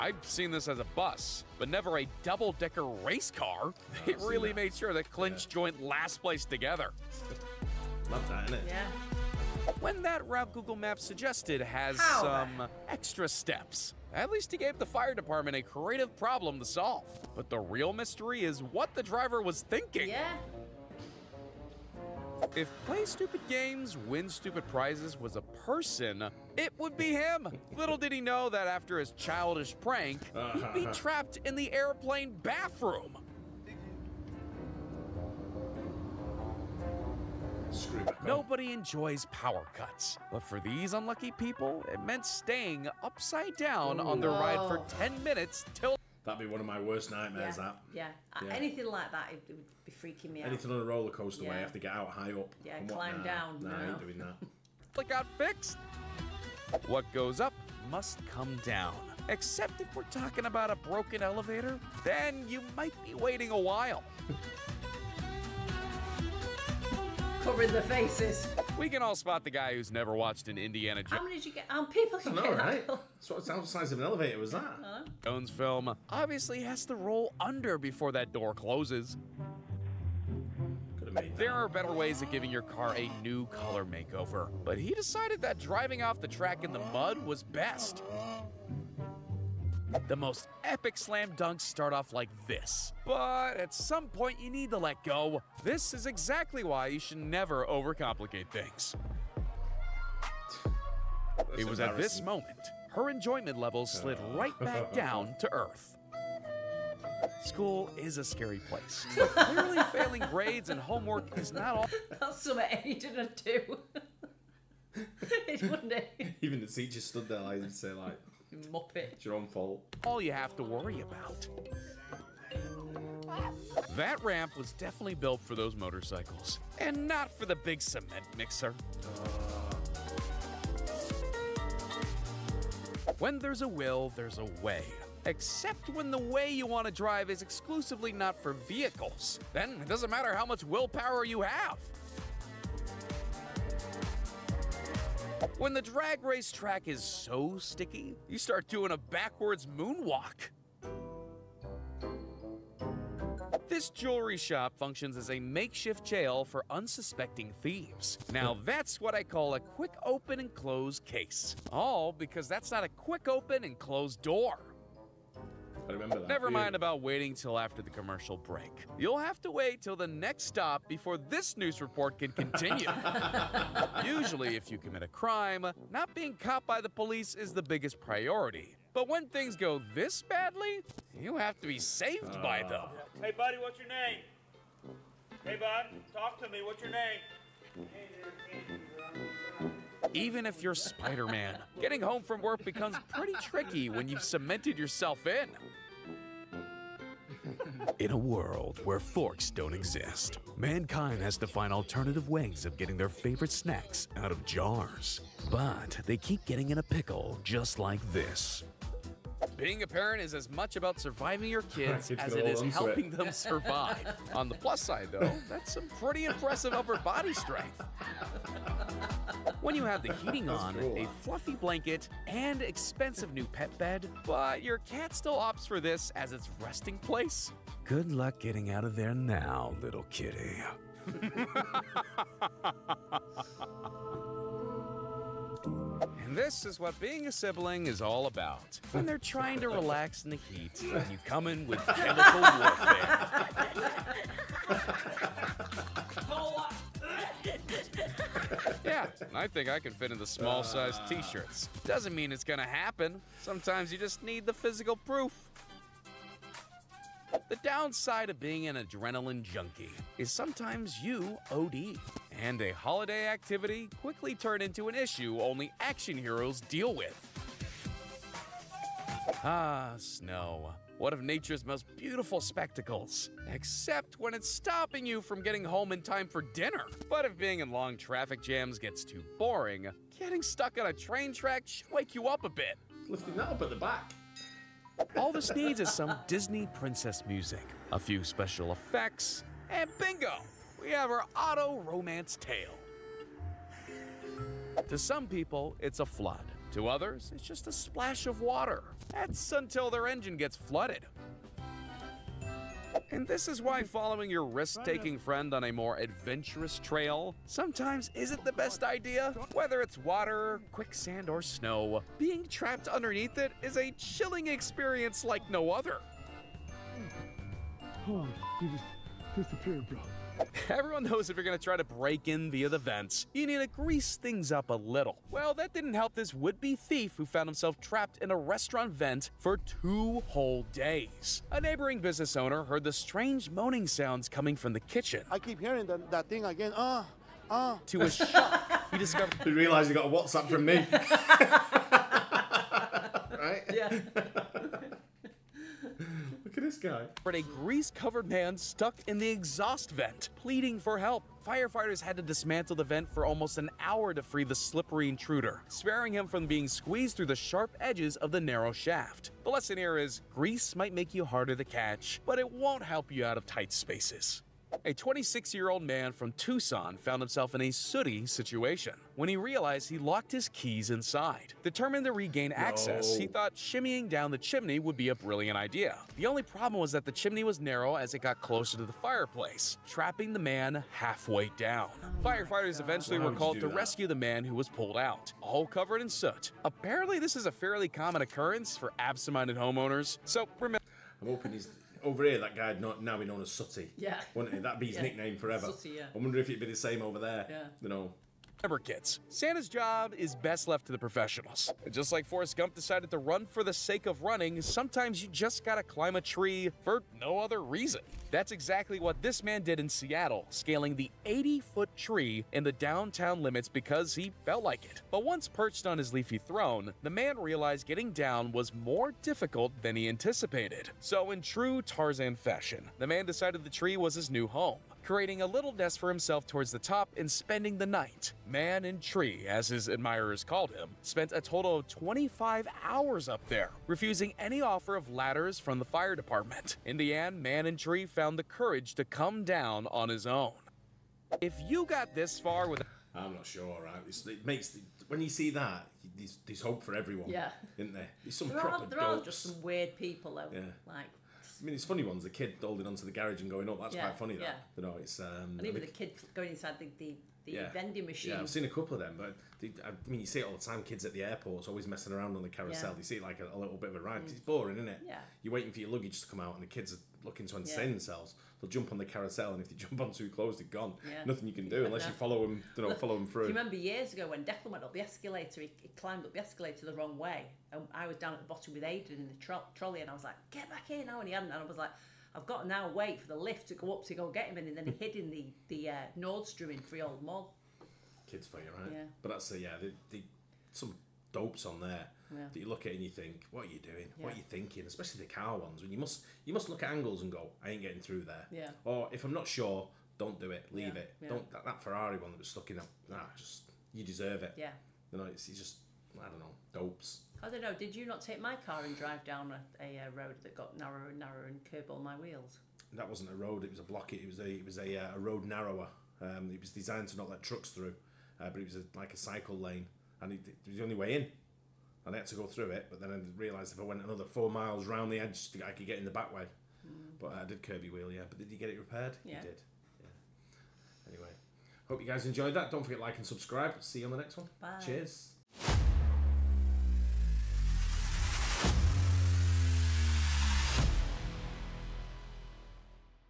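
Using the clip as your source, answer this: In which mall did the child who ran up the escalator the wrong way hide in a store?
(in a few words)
Freehold Mall.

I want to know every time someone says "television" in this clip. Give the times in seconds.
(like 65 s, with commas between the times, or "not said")
not said.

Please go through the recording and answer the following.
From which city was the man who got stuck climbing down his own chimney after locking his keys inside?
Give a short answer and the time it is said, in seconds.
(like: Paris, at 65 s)
Tucson, at 366 s.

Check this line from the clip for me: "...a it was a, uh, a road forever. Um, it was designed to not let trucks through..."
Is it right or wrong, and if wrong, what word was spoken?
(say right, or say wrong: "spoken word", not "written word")
wrong: "narrower", not "forever".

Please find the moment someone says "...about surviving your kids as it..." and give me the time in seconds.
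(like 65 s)
210 s.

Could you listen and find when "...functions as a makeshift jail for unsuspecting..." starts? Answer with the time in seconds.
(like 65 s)
154 s.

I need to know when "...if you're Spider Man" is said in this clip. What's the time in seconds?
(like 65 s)
190 s.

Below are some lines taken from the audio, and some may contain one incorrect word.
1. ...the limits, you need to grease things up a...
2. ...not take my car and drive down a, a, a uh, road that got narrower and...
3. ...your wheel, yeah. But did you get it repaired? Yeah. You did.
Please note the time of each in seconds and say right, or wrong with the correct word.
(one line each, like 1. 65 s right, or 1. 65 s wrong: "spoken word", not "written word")
1. 322 s wrong: "vents", not "limits"
2. 508 s right
3. 527 s right.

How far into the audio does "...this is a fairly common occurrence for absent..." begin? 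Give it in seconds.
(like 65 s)
387 s.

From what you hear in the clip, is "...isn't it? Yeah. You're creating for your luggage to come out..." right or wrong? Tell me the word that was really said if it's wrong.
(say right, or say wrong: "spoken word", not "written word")
wrong: "waiting", not "creating".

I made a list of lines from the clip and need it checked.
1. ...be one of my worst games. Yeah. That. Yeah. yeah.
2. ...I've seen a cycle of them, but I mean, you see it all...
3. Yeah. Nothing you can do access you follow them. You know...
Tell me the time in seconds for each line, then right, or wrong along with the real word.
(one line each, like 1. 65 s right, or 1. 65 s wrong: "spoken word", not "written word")
1. 46 s wrong: "nightmares", not "games"
2. 458 s wrong: "couple", not "cycle"
3. 471 s wrong: "unless", not "access".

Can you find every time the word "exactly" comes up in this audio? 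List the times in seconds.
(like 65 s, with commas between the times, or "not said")
96 s, 408 s.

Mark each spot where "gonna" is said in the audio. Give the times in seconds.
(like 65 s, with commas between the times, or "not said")
252 s, 321 s.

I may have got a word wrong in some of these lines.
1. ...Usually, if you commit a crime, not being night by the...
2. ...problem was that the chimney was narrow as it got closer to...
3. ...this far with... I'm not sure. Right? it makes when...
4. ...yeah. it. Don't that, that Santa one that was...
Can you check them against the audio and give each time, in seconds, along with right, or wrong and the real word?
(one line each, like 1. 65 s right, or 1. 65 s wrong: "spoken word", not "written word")
1. 174 s wrong: "caught", not "night"
2. 376 s right
3. 442 s right
4. 500 s wrong: "Ferrari", not "Santa".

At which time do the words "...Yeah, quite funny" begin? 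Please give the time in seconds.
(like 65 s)
453 s.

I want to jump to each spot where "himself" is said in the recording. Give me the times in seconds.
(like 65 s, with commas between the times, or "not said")
327 s, 367 s, 426 s.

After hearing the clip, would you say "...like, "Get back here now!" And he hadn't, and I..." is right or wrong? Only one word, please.
right.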